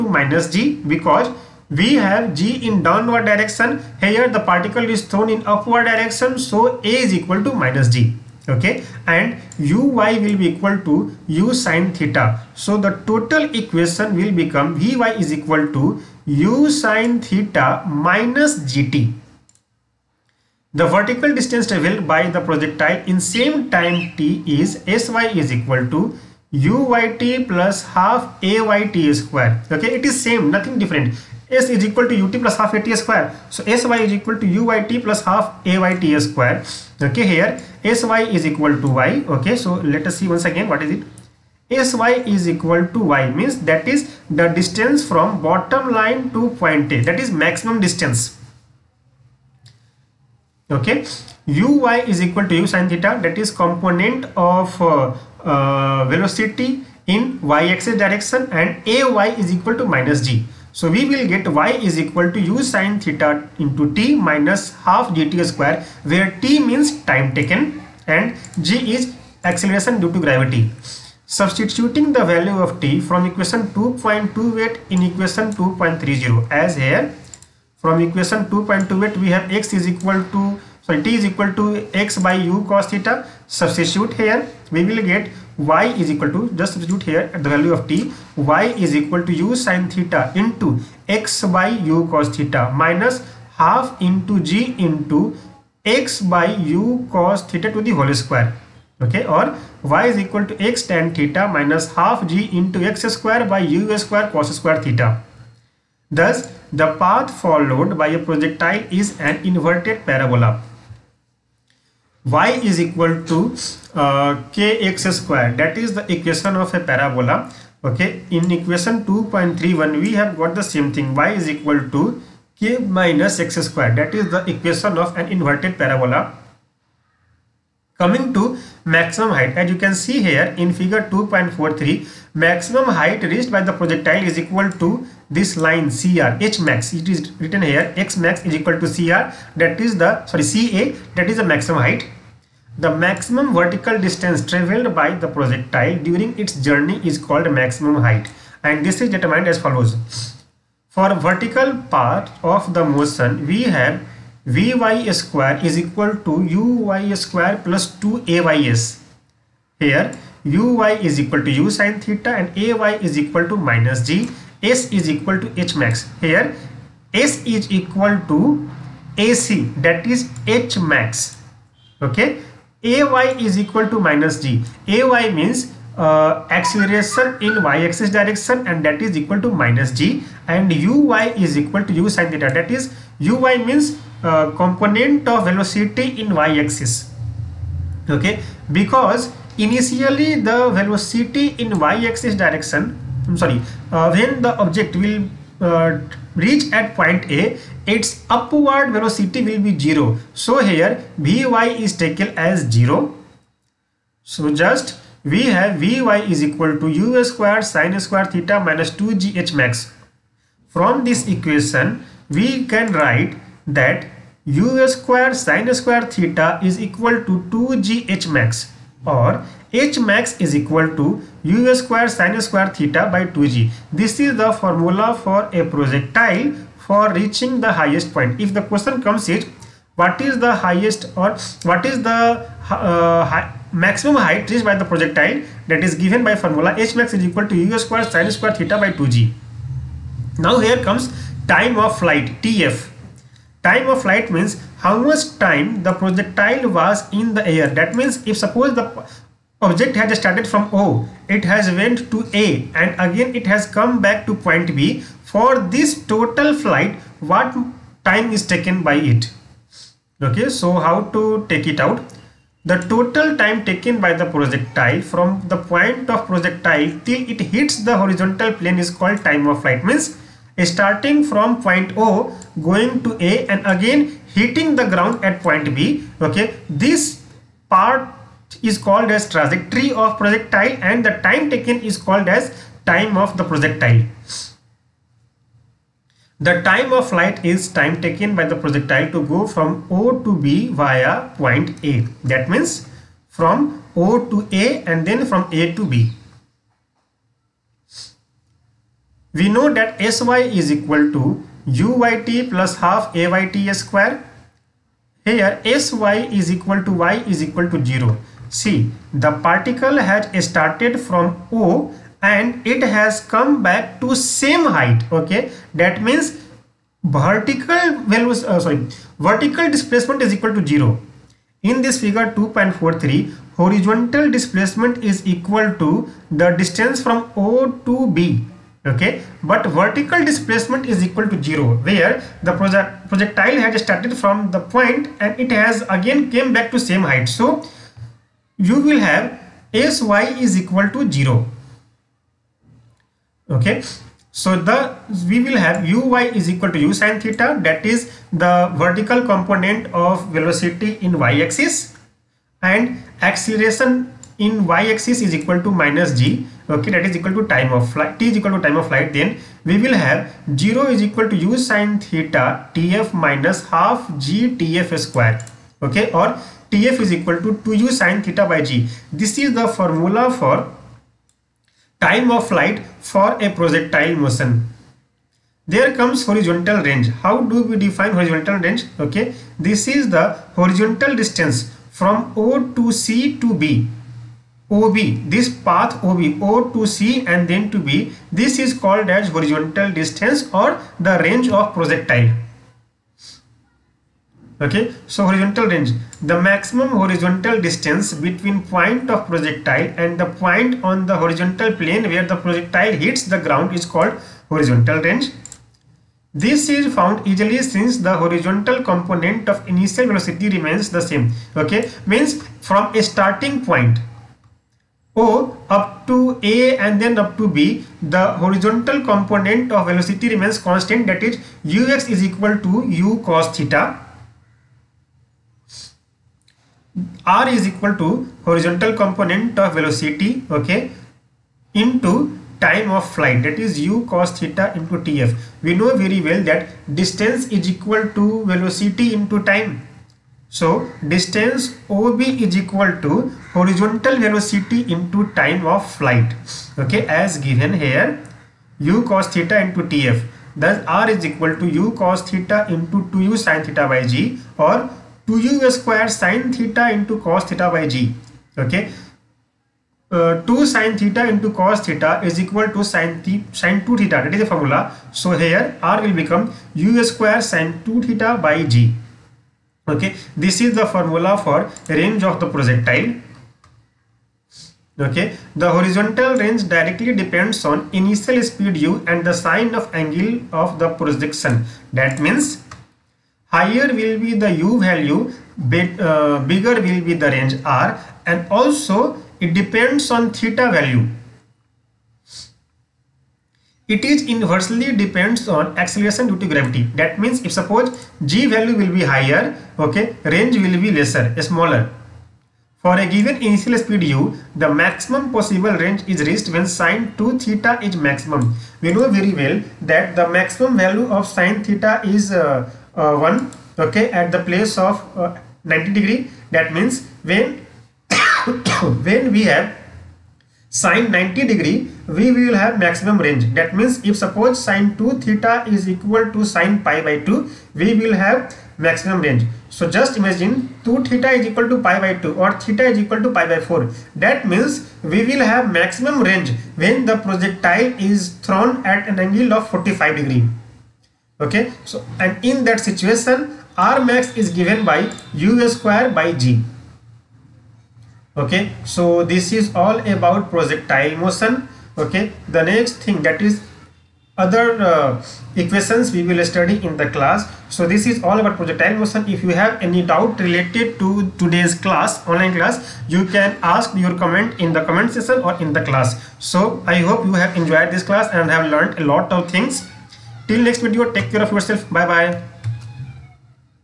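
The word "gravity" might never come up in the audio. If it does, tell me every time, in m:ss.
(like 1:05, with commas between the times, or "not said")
1:10, 8:16.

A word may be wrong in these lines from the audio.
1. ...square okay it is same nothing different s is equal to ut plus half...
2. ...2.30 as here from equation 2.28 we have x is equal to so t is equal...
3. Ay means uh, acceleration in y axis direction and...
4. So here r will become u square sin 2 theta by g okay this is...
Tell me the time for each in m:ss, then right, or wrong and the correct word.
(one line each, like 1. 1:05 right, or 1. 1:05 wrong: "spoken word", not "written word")
1. 0:29 right
2. 1:15 right
3. 2:54 right
4. 7:45 right.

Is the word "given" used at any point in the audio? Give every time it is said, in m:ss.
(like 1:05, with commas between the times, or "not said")
3:55, 7:27, 8:23, 9:04.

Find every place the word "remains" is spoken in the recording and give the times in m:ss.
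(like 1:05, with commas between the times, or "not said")
6:50, 7:00.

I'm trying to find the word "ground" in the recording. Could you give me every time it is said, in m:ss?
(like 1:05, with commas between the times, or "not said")
4:34, 6:43.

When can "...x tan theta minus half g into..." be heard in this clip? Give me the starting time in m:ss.
1:40.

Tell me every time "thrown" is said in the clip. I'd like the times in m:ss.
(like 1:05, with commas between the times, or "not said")
0:05, 8:58.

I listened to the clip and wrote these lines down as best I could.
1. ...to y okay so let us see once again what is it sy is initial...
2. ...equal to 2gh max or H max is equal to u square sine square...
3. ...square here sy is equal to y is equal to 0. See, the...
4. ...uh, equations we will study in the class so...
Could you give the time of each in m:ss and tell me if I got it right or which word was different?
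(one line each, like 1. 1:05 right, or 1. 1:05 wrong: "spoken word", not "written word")
1. 0:38 wrong: "equal", not "initial"
2. 3:36 right
3. 5:03 right
4. 9:14 right.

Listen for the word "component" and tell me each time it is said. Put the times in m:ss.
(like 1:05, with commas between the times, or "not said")
0:53, 3:04, 5:49, 6:48, 6:58, 7:09.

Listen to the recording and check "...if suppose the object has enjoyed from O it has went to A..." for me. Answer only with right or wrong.
wrong.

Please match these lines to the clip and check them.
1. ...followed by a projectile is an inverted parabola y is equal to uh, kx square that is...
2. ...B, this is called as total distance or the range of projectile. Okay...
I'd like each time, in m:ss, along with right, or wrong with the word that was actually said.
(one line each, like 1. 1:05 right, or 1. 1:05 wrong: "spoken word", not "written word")
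1. 1:47 right
2. 6:27 wrong: "horizontal", not "total".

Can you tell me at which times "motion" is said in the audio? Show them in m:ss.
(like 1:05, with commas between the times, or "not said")
2:32, 6:14, 9:11, 9:18.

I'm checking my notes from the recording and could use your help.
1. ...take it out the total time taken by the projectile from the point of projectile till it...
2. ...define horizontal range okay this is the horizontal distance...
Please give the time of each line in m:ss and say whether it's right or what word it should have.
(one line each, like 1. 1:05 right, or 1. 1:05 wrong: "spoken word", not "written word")
1. 4:21 right
2. 6:17 right.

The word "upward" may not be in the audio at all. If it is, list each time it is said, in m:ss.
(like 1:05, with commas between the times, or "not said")
0:05, 3:18.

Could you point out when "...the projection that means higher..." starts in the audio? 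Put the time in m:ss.
8:00.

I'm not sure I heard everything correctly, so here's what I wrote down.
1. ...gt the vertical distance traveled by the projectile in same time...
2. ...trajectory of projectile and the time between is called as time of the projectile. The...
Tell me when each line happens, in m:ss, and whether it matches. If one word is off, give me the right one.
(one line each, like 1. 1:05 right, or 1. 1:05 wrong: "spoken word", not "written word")
1. 0:18 right
2. 4:39 wrong: "taken", not "between".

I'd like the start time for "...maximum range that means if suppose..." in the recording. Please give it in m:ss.
8:42.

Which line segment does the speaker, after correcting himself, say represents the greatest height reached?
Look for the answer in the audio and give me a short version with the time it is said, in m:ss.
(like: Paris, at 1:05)
CA, at 2:20.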